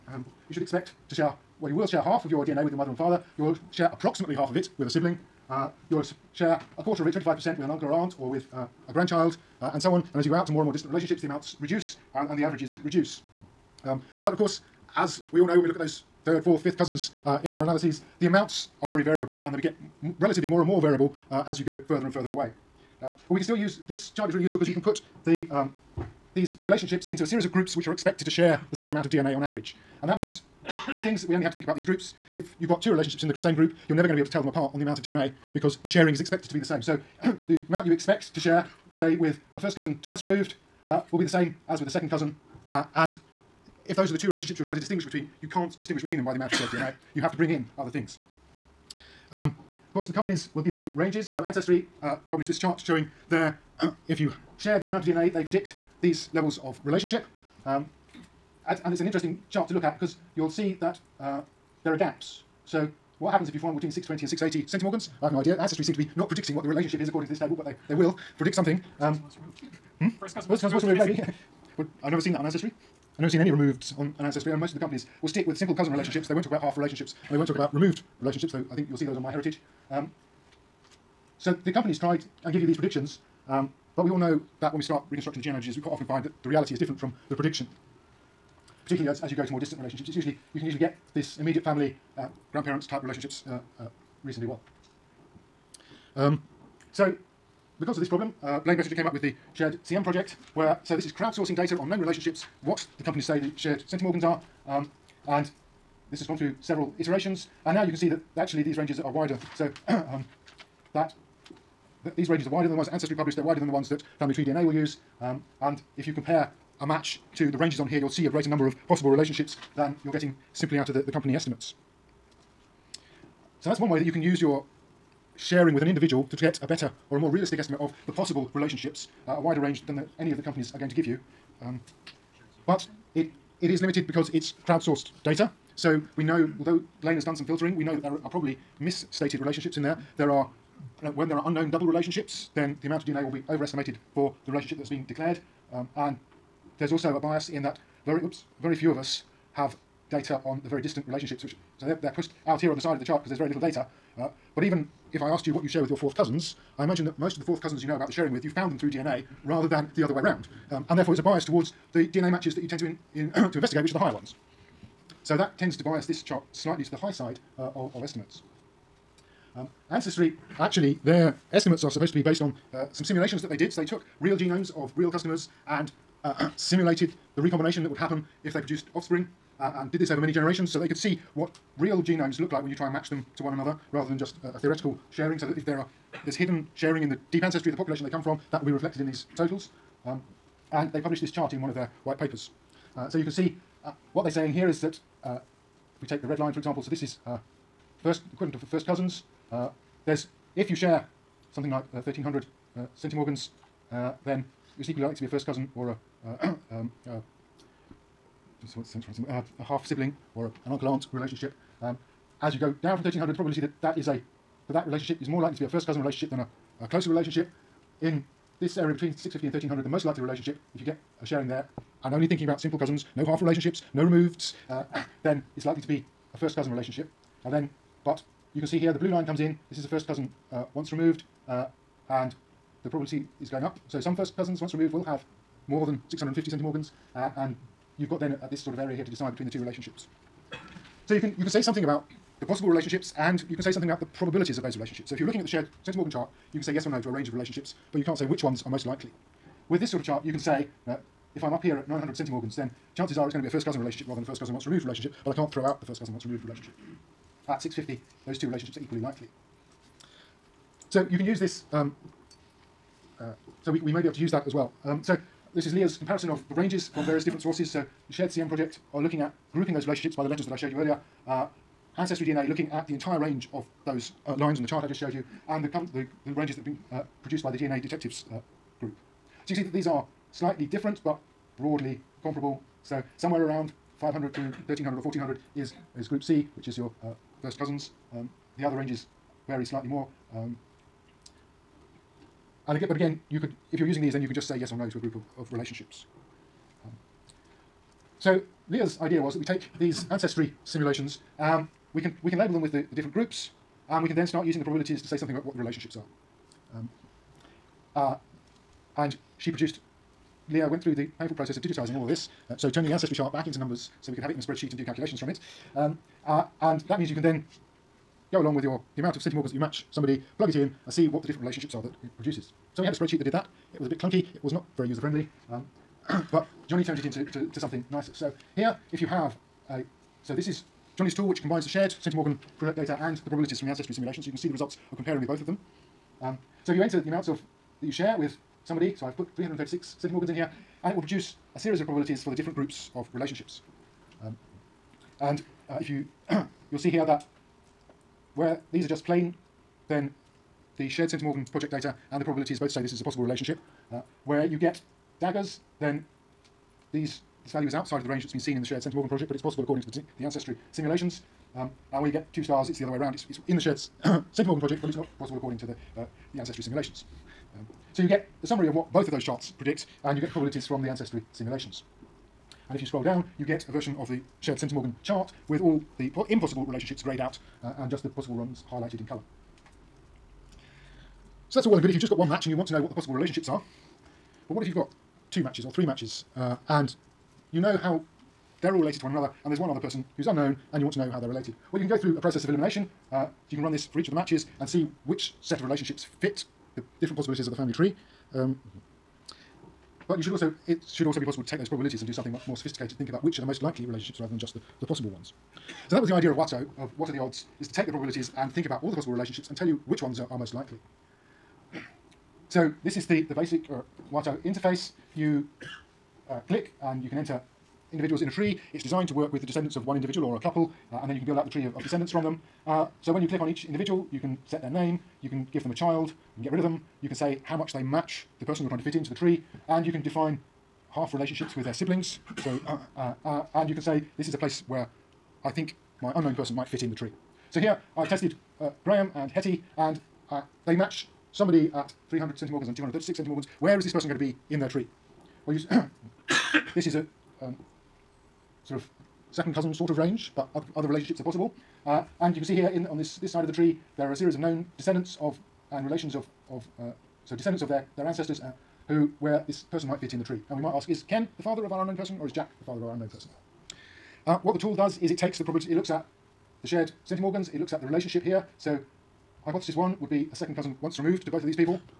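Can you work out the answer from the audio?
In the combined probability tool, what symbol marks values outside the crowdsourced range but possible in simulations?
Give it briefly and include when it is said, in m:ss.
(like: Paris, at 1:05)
daggers, at 5:55.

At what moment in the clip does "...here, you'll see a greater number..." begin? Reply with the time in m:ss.
1:57.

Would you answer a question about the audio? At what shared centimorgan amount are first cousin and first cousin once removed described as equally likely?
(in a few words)
650.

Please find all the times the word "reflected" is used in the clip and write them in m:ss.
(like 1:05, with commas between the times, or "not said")
3:08.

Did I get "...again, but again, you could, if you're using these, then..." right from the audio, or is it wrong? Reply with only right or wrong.
right.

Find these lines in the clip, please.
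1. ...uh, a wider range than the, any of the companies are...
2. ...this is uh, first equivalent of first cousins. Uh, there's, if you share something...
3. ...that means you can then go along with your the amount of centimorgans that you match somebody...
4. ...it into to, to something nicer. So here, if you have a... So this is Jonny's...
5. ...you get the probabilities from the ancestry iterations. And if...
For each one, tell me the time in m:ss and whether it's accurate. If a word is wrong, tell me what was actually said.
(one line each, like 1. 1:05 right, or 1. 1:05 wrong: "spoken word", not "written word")
1. 2:09 right
2. 3:16 right
3. 5:16 right
4. 5:26 wrong: "Johnny", not "Jonny"
5. 6:10 wrong: "simulations", not "iterations".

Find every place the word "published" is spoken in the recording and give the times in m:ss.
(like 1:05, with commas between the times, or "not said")
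0:52, 1:53, 3:10.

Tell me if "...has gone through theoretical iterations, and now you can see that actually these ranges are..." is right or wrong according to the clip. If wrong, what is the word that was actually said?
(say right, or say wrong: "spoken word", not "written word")
wrong: "several", not "theoretical".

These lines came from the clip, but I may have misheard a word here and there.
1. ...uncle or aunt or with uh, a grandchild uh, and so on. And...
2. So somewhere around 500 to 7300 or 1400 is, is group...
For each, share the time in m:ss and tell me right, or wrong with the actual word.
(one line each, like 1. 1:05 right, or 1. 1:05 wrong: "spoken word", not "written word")
1. 0:07 right
2. 4:42 wrong: "1300", not "7300".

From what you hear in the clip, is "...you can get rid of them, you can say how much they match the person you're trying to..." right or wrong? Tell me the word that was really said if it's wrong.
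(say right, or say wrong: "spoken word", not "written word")
right.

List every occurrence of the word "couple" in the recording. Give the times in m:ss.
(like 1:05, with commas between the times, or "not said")
7:00.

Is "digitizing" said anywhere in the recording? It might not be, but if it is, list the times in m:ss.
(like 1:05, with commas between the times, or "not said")
5:11.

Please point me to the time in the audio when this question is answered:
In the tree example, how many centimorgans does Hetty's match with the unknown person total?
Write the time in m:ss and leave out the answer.
7:22.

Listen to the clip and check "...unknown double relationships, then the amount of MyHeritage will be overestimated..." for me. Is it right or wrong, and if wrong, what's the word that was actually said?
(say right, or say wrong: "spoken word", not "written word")
wrong: "DNA", not "MyHeritage".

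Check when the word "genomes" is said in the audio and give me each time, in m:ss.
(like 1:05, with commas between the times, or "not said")
2:54, 3:02.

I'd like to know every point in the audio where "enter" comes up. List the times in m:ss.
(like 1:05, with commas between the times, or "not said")
5:36, 6:57.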